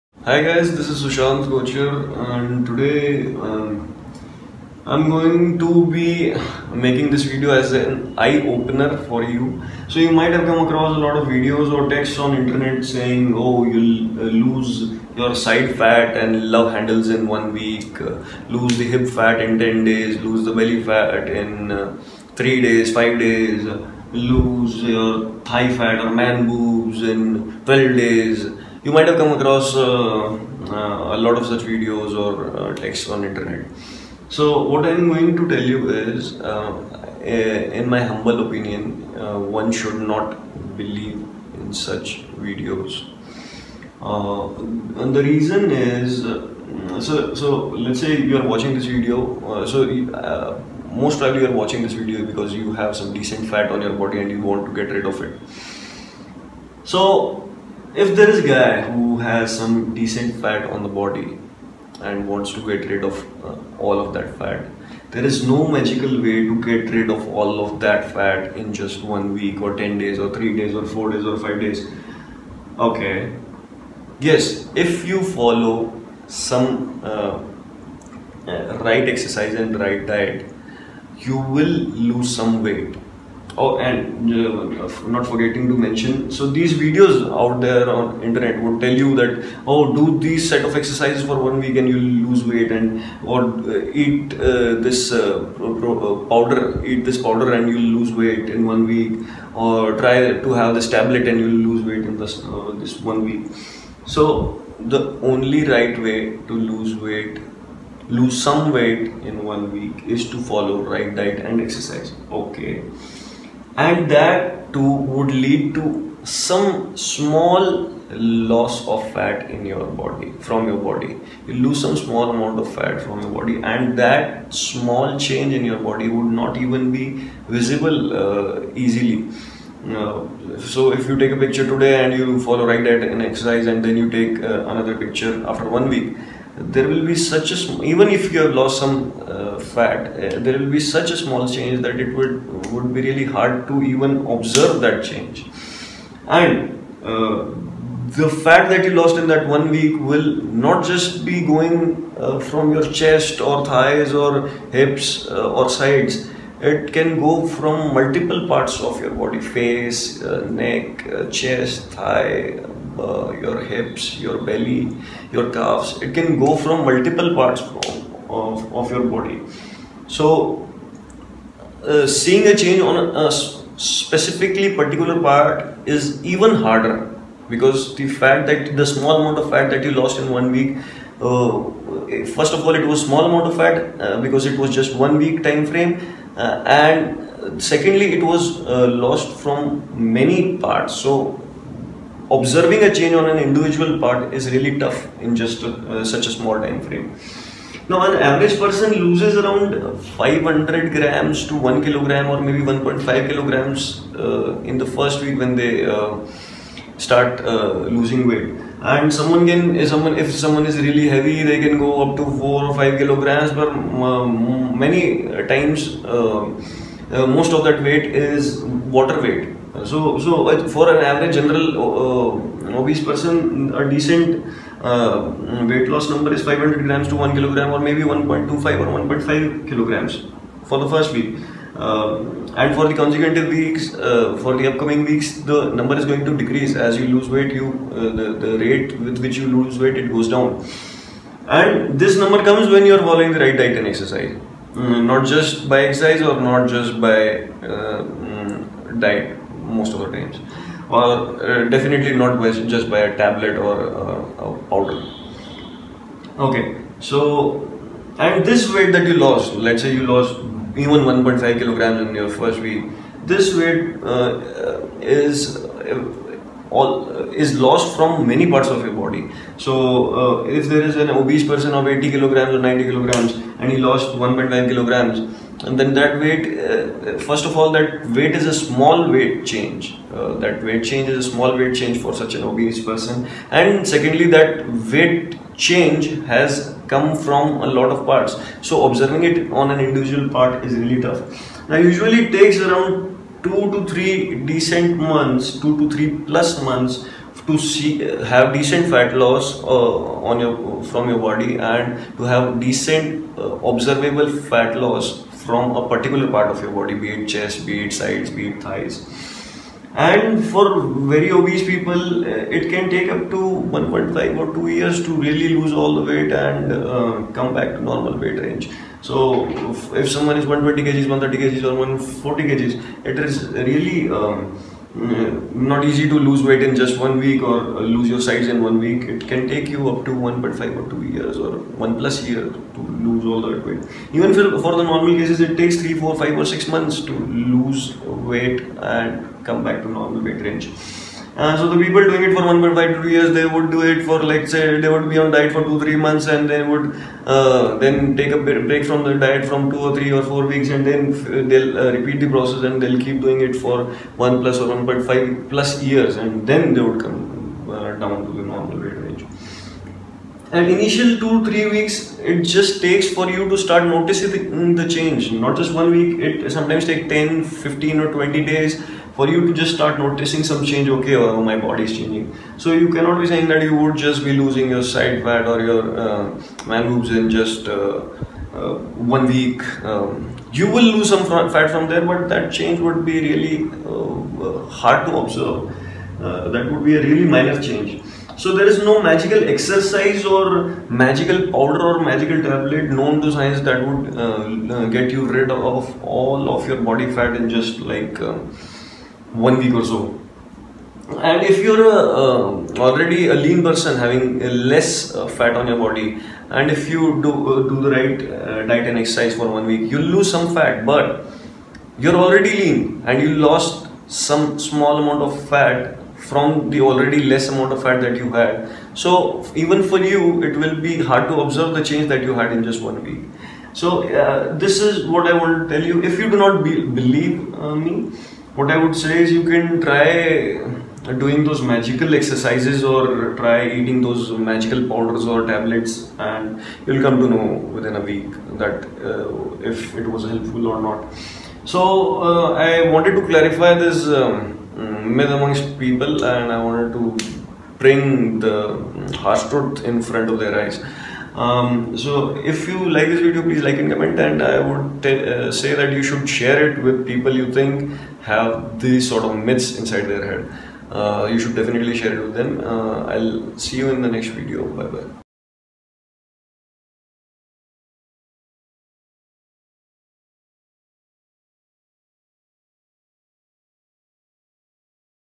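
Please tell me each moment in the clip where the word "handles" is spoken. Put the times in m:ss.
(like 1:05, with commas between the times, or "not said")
0:16.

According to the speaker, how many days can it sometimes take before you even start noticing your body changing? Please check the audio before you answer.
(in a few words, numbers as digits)
10, 15 or 20 days.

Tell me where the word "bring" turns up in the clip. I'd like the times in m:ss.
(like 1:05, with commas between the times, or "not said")
7:27.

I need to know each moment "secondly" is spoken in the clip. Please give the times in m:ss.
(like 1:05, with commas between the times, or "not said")
3:07, 4:43.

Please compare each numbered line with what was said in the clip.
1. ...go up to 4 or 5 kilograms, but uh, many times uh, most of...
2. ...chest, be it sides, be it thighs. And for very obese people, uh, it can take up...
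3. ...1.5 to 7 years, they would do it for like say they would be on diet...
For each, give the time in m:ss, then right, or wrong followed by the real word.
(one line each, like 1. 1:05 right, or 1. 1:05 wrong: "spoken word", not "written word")
1. 3:31 right
2. 5:07 right
3. 5:42 wrong: "2", not "7".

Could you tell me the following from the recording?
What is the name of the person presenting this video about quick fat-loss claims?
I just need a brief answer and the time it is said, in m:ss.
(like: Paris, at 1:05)
Sushant Kocher, at 0:01.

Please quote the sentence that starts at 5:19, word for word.
So if someone is 120 kgs, 130 kgs or 140 kgs, it is really um, Mm-hmm.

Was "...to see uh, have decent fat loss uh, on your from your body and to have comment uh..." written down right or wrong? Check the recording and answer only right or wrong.
wrong.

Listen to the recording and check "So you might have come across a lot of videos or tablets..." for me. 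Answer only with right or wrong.
wrong.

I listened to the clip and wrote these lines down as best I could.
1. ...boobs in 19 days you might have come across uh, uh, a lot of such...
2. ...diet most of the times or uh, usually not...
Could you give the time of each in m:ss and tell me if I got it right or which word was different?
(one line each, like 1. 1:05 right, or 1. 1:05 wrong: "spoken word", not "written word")
1. 0:26 wrong: "12", not "19"
2. 4:08 wrong: "definitely", not "usually".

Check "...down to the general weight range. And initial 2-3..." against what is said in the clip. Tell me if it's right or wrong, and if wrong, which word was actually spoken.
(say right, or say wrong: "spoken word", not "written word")
wrong: "normal", not "general".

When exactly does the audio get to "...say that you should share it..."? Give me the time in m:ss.
7:35.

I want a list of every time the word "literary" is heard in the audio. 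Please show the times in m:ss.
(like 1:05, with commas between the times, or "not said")
not said.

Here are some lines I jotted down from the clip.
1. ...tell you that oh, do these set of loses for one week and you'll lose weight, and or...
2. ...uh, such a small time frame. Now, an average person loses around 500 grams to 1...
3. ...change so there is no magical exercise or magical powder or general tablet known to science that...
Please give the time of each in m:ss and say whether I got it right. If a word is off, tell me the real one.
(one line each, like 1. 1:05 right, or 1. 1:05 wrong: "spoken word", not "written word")
1. 1:28 wrong: "exercises", not "loses"
2. 3:15 right
3. 6:27 wrong: "magical", not "general".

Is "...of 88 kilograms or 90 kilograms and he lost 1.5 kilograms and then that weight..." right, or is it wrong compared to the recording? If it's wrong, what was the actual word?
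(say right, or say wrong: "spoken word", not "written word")
wrong: "80", not "88".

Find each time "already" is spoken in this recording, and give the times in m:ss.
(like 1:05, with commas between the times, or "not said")
6:42, 6:52, 6:56.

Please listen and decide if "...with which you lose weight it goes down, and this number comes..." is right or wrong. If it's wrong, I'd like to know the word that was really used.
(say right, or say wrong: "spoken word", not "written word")
right.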